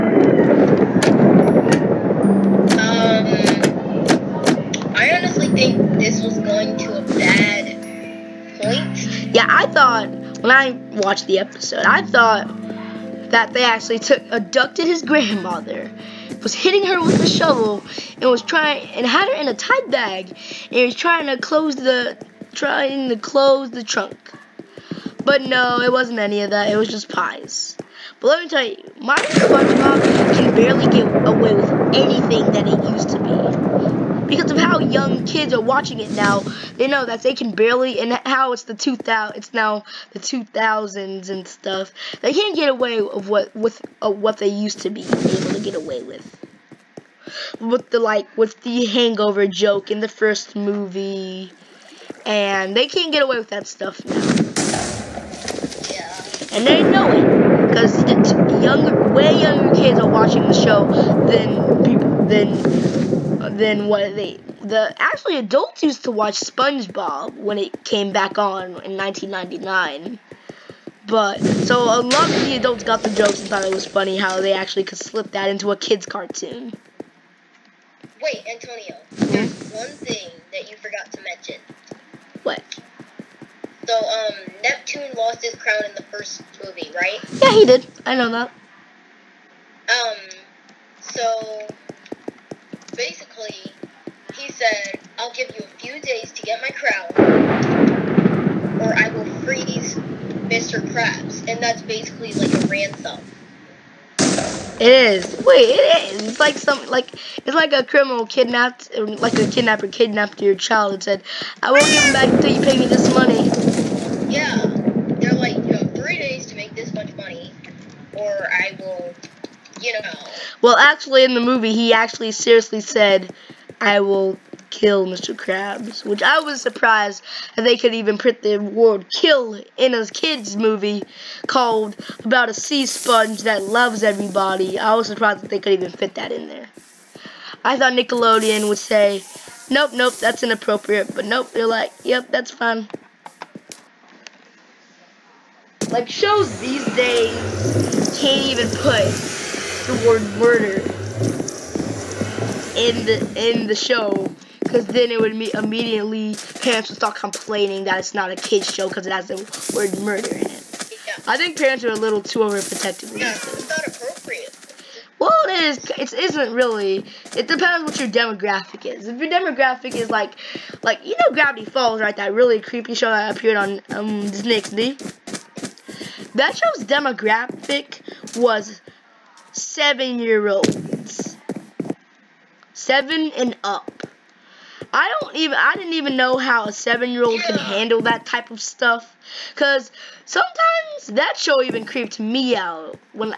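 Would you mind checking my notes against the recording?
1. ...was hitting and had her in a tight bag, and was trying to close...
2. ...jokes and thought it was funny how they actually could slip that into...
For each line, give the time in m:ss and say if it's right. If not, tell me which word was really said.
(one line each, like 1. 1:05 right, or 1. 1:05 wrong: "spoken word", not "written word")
1. 0:18 wrong: "trying", not "hitting"
2. 1:13 right.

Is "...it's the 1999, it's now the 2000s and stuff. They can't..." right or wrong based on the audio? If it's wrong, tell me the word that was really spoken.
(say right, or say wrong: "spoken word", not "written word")
wrong: "2000", not "1999".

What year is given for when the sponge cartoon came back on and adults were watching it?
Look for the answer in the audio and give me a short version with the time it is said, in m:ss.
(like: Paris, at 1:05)
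1999, at 1:08.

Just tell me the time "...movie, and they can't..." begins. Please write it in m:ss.
0:50.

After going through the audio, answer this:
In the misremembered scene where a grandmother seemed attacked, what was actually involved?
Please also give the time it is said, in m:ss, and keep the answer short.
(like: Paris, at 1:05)
Pies, at 0:27.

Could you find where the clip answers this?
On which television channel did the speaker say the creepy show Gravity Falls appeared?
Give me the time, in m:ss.
2:54.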